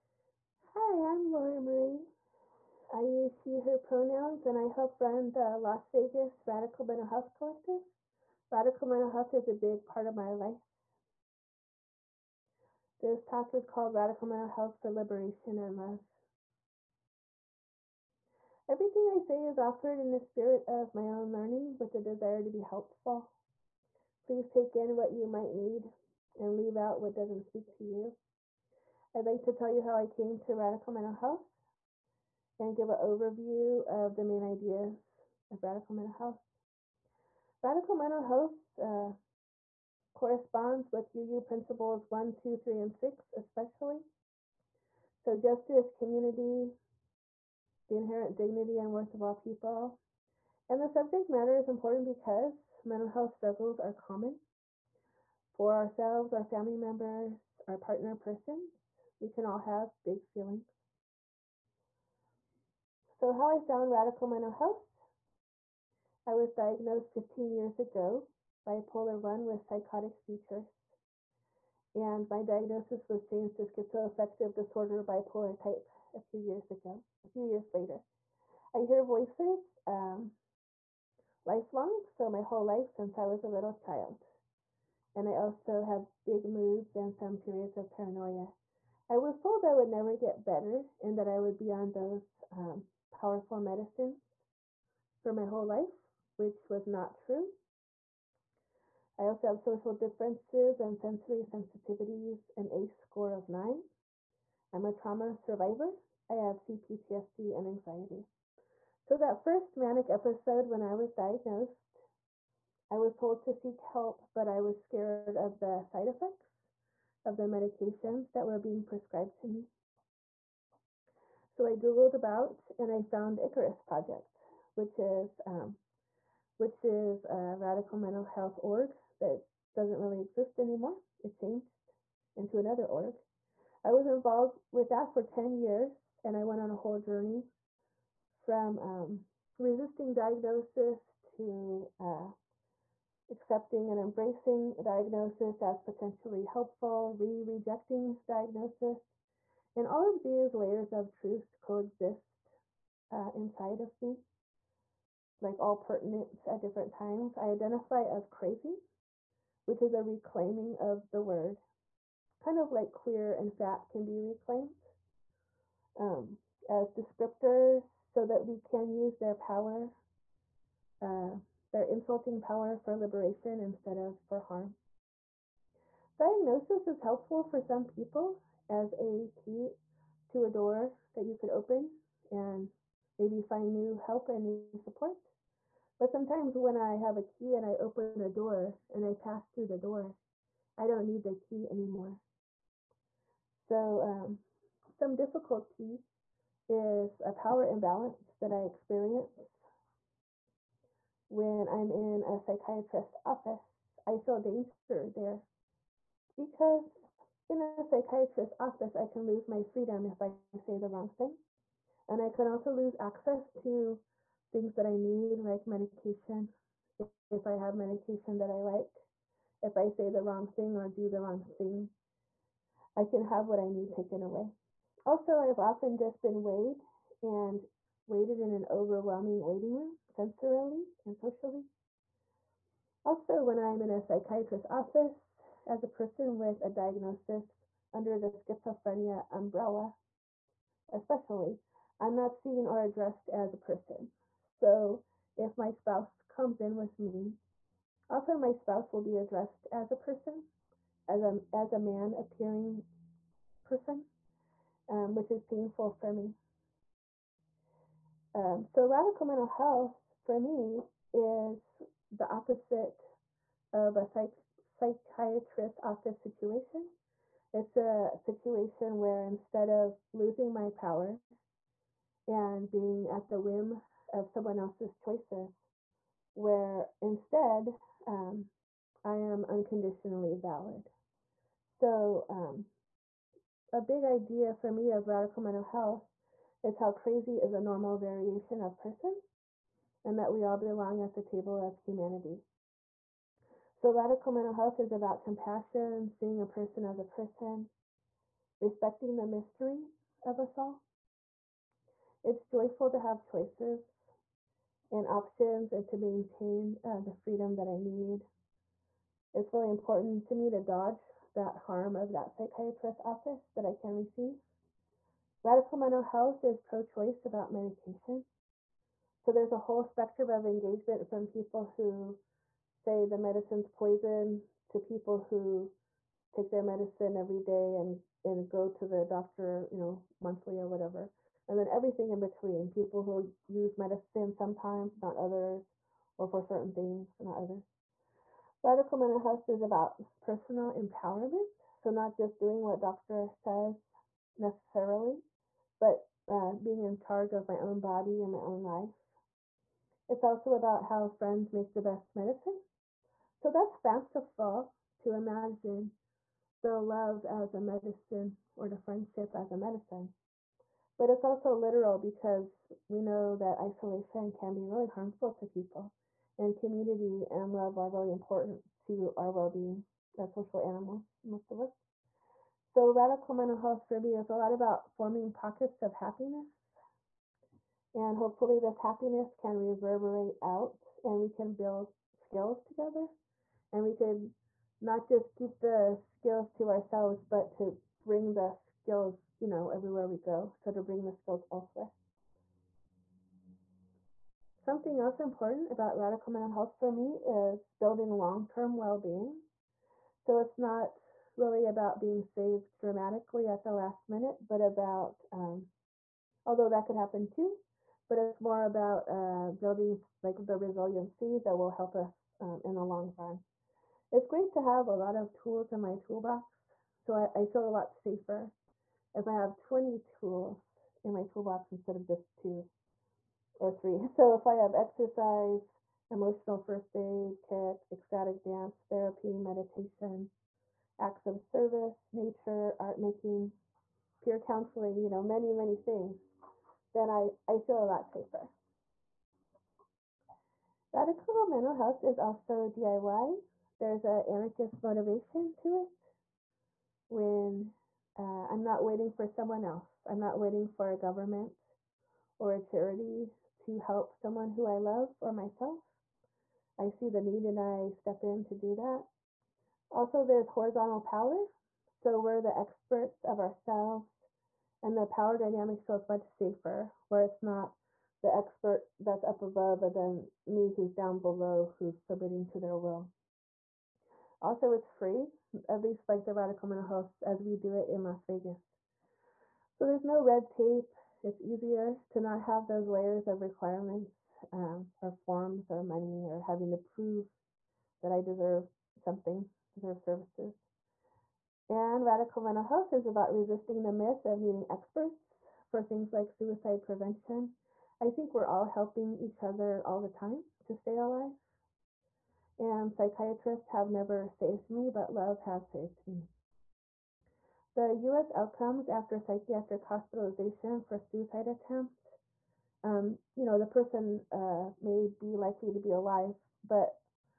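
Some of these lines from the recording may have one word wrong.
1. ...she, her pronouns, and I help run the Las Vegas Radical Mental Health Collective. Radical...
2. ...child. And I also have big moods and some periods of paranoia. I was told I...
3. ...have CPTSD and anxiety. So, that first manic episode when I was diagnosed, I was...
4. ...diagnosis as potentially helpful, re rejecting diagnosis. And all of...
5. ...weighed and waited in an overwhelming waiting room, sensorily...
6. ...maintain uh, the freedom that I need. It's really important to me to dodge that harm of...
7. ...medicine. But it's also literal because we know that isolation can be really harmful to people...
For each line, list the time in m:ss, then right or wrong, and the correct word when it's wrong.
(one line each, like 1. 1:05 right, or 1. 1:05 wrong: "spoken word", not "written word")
1. 0:03 right
2. 1:23 right
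3. 1:46 right
4. 2:24 right
5. 3:46 right
6. 5:05 right
7. 5:59 right.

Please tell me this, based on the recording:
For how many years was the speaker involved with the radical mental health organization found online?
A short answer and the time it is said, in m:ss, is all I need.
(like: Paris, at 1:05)
10 years, at 2:15.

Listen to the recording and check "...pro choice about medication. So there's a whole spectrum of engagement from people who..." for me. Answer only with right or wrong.
right.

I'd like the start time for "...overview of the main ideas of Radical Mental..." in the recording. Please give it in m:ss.
0:33.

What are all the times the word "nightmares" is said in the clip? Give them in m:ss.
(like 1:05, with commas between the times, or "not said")
not said.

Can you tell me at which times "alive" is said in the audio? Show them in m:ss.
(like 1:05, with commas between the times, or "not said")
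8:20, 8:35.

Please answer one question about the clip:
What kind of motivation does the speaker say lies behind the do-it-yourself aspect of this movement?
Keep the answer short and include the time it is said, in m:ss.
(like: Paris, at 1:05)
anarchist, at 7:24.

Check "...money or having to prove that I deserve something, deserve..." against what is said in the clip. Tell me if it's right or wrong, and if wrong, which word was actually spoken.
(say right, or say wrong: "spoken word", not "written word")
right.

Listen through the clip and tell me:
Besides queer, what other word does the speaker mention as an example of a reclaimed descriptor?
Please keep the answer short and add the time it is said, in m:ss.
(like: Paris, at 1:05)
fat, at 2:43.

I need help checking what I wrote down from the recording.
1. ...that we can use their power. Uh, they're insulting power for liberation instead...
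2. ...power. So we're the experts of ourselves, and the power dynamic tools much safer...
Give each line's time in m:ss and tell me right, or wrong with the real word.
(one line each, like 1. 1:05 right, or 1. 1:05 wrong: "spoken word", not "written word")
1. 2:48 right
2. 7:41 wrong: "feels", not "tools".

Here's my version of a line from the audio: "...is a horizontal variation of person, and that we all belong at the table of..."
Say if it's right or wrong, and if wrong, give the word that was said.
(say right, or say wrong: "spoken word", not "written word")
wrong: "normal", not "horizontal".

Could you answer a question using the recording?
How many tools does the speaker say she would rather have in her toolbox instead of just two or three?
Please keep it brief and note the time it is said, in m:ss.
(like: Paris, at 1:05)
20, at 6:59.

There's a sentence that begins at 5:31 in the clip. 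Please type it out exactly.
And then everything in between, people who use medicine sometimes, not others, or for certain things, not others.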